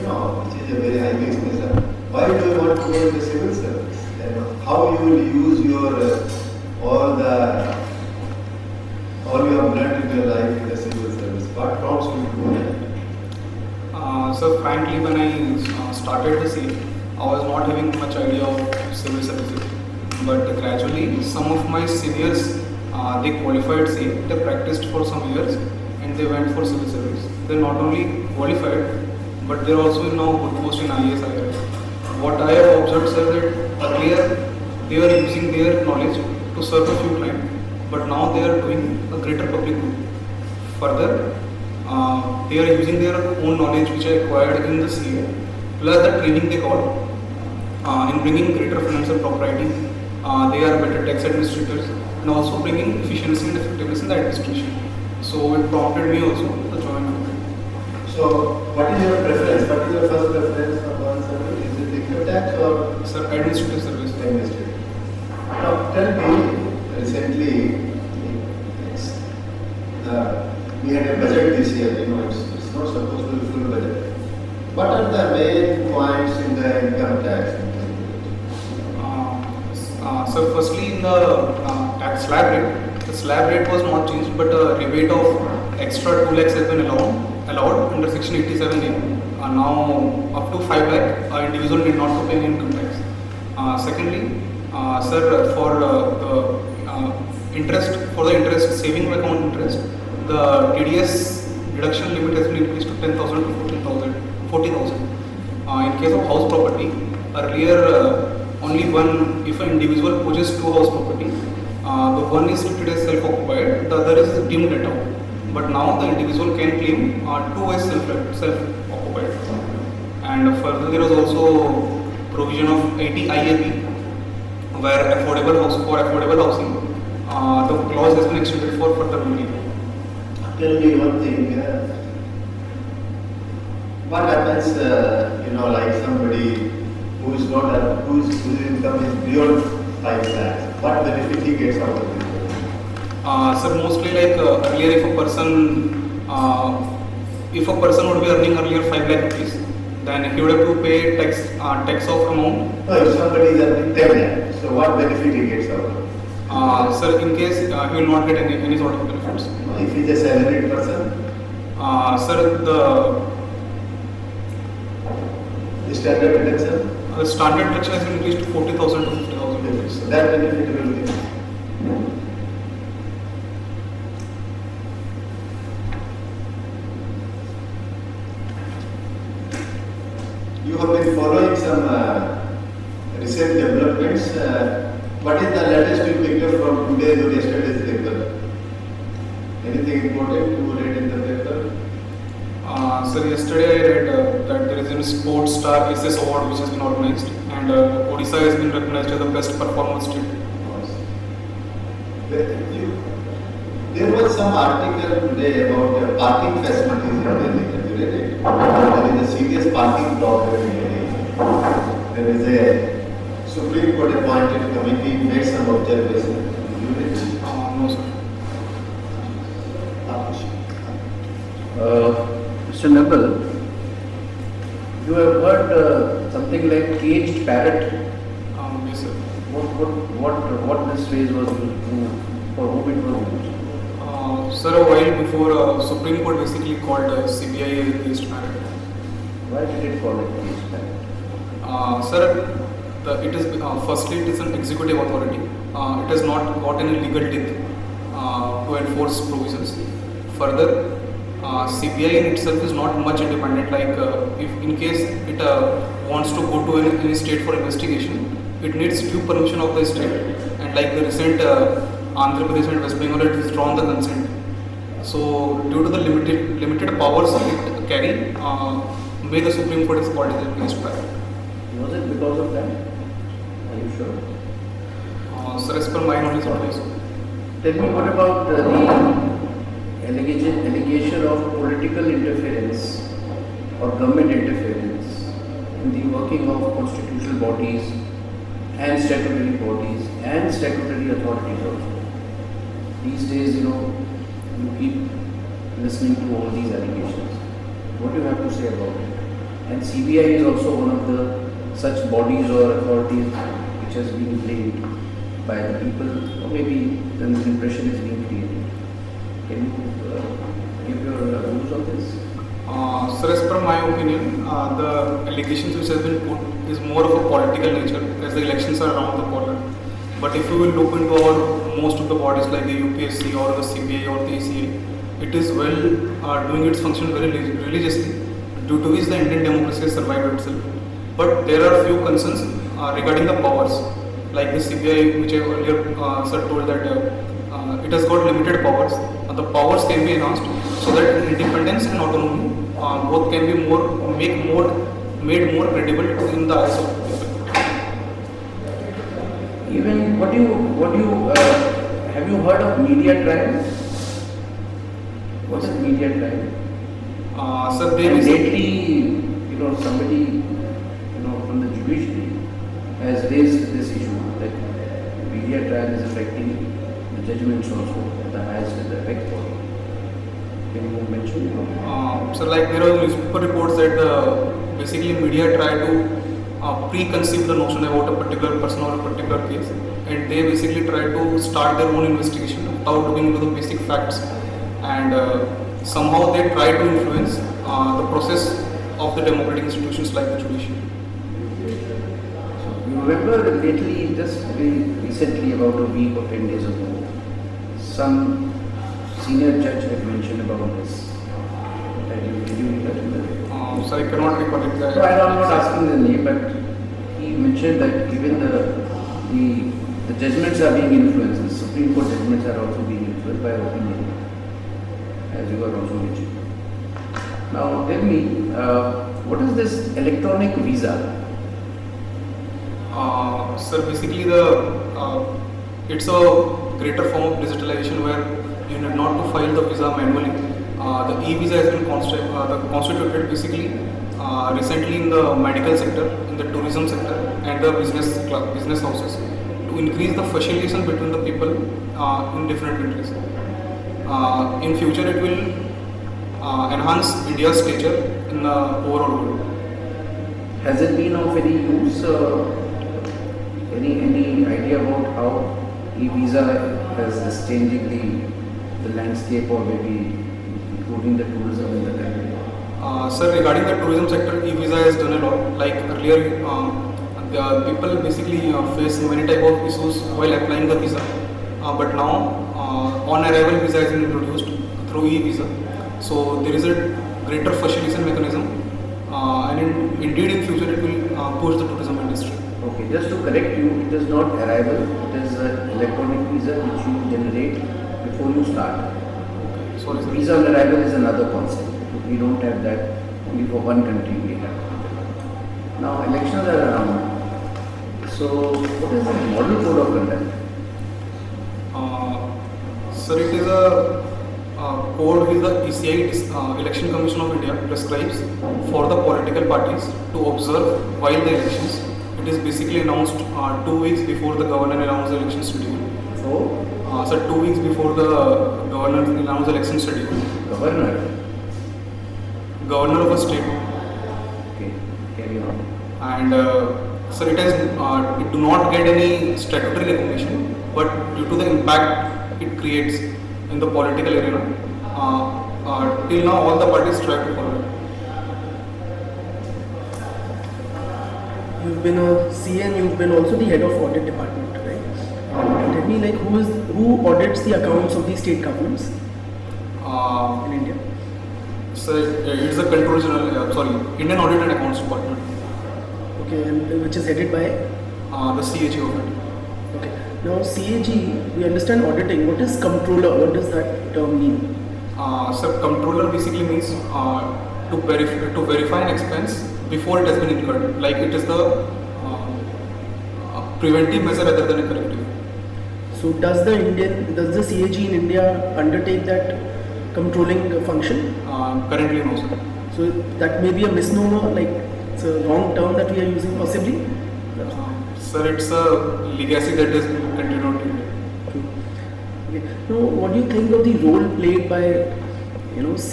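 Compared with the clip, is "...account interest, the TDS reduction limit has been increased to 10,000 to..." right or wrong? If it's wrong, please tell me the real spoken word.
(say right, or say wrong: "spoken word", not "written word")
right.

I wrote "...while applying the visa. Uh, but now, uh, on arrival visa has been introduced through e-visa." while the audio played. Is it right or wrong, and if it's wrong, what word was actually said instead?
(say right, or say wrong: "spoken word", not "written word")
right.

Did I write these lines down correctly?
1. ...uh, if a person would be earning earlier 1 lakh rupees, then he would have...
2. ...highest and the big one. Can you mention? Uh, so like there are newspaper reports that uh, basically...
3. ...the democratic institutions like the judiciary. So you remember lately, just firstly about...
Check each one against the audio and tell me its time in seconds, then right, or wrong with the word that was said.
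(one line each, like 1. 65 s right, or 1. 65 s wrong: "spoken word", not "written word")
1. 146 s wrong: "5", not "1"
2. 368 s right
3. 389 s wrong: "recently", not "firstly".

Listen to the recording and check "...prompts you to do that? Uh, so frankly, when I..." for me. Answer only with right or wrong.
right.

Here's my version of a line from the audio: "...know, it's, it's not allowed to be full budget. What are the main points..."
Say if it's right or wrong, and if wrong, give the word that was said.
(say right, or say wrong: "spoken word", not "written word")
wrong: "supposed", not "allowed".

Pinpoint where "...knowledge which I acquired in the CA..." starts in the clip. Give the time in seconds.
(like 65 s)
43 s.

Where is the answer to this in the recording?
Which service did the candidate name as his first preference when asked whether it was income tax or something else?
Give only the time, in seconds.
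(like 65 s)
63 s.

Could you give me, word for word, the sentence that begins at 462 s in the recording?
Uh, sir, regarding the tourism sector, e-visa has done a lot.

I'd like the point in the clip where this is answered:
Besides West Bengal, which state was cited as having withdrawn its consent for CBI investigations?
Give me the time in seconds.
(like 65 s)
262 s.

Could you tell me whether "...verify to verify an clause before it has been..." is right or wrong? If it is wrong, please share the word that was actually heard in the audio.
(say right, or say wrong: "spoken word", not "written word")
wrong: "expense", not "clause".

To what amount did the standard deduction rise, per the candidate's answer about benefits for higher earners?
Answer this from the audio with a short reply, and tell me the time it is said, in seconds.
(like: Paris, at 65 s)
50,000, at 169 s.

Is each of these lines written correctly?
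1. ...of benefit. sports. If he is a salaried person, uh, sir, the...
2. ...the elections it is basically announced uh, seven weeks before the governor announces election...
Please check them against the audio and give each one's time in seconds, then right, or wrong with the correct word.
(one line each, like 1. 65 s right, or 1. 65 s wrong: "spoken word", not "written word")
1. 158 s right
2. 511 s wrong: "two", not "seven".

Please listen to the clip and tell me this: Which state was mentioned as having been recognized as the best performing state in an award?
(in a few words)
Odisha.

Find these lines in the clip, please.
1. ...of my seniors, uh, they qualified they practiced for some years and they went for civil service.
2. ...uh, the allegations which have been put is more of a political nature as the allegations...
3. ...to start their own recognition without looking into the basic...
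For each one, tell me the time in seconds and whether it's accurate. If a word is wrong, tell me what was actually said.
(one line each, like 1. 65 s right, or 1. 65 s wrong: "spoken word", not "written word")
1. 21 s right
2. 314 s wrong: "elections", not "allegations"
3. 381 s wrong: "investigation", not "recognition".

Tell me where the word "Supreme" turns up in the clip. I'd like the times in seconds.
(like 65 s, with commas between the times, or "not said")
213 s, 235 s, 269 s, 411 s.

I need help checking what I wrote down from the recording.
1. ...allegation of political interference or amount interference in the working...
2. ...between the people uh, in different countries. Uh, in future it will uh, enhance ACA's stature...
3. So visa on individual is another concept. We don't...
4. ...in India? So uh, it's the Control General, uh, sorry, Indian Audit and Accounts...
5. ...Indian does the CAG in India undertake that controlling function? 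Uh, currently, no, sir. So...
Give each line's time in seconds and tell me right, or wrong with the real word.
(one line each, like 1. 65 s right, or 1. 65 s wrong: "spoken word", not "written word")
1. 280 s wrong: "government", not "amount"
2. 440 s wrong: "India", not "ACA"
3. 489 s wrong: "arrival", not "individual"
4. 550 s right
5. 576 s right.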